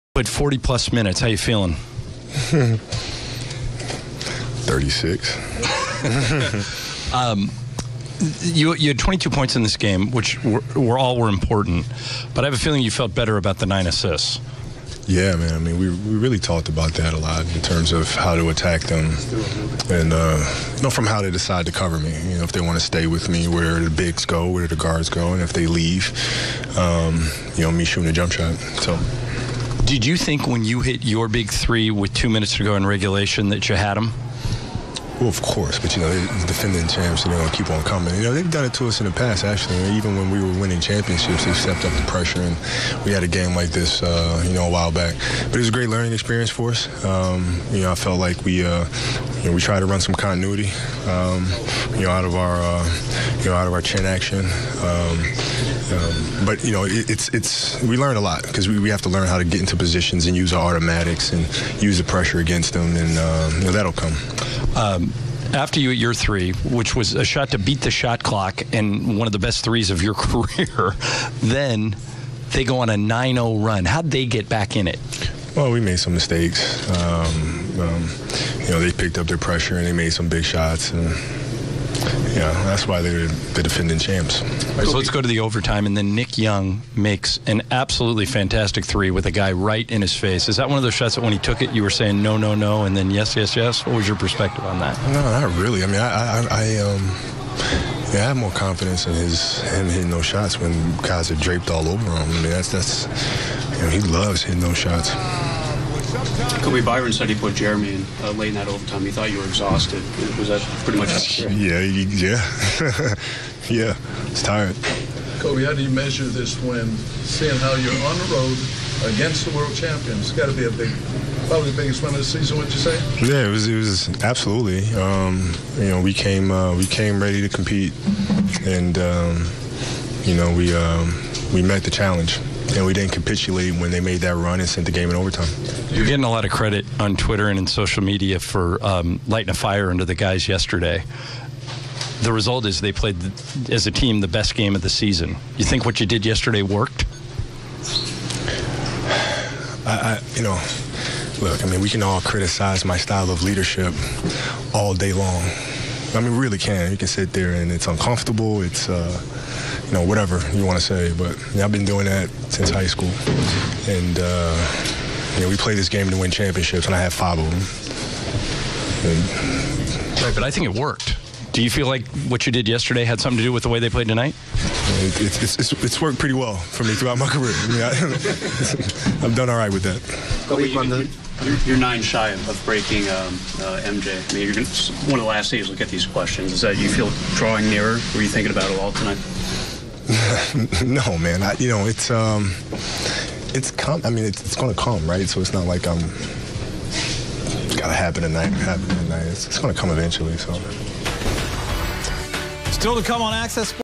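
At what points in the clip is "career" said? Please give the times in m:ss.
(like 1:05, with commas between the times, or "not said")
1:10, 2:57.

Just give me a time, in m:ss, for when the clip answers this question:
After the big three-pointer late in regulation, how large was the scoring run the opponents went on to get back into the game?
1:12.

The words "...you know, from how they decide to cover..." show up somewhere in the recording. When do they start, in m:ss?
0:20.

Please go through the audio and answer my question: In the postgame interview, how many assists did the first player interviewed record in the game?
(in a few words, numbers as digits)
9.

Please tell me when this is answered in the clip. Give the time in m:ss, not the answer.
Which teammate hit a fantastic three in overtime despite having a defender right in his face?
1:26.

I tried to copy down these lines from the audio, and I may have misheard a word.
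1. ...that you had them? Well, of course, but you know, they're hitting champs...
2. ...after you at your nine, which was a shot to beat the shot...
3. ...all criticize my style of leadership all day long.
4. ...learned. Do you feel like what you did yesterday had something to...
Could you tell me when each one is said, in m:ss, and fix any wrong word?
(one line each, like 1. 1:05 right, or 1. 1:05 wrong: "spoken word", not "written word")
1. 0:33 wrong: "defending", not "hitting"
2. 1:05 wrong: "three", not "nine"
3. 2:32 right
4. 2:50 wrong: "worked", not "learned".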